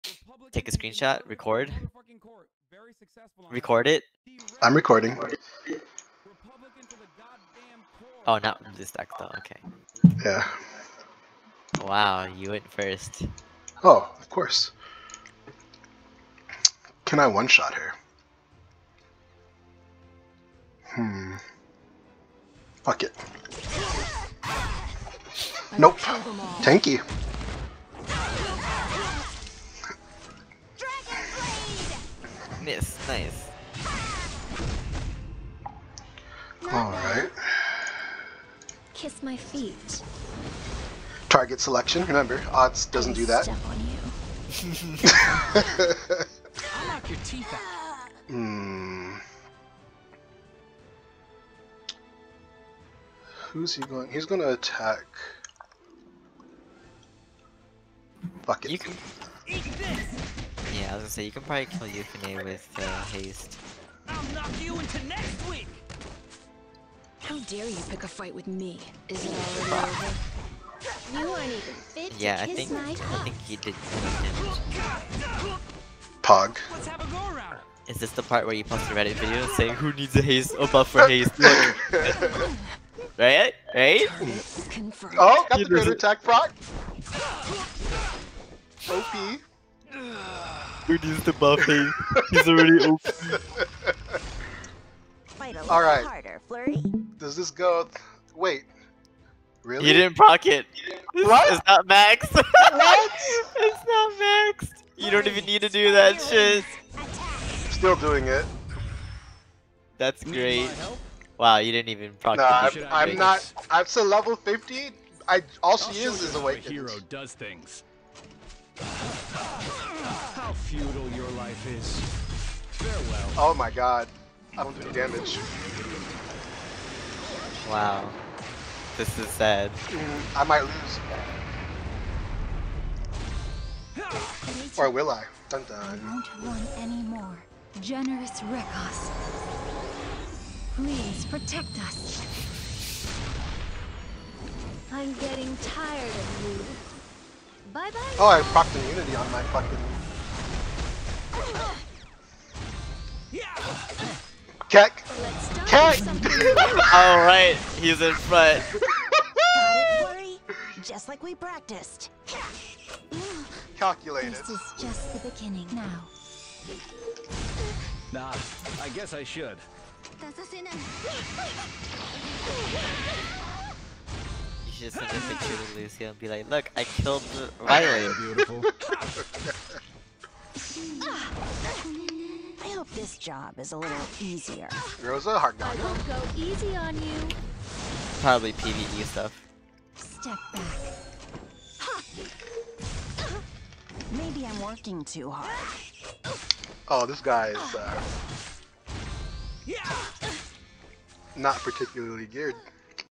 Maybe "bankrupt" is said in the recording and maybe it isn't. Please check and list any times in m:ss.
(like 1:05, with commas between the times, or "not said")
not said.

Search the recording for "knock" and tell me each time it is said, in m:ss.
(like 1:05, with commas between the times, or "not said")
0:46, 1:04.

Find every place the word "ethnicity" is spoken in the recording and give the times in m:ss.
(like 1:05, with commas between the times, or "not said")
not said.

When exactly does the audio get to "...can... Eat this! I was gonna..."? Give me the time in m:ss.
0:58.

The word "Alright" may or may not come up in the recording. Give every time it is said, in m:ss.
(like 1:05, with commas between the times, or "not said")
0:36, 2:36.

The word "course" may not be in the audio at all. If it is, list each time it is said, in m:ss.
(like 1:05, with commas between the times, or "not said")
0:14.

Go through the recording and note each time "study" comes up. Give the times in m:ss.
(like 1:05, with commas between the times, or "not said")
not said.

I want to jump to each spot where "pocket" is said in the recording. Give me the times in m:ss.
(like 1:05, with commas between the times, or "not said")
1:40, 1:52.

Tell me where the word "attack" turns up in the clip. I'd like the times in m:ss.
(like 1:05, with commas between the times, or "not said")
0:54, 1:25.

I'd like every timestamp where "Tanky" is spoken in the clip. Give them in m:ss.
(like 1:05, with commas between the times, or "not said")
0:25.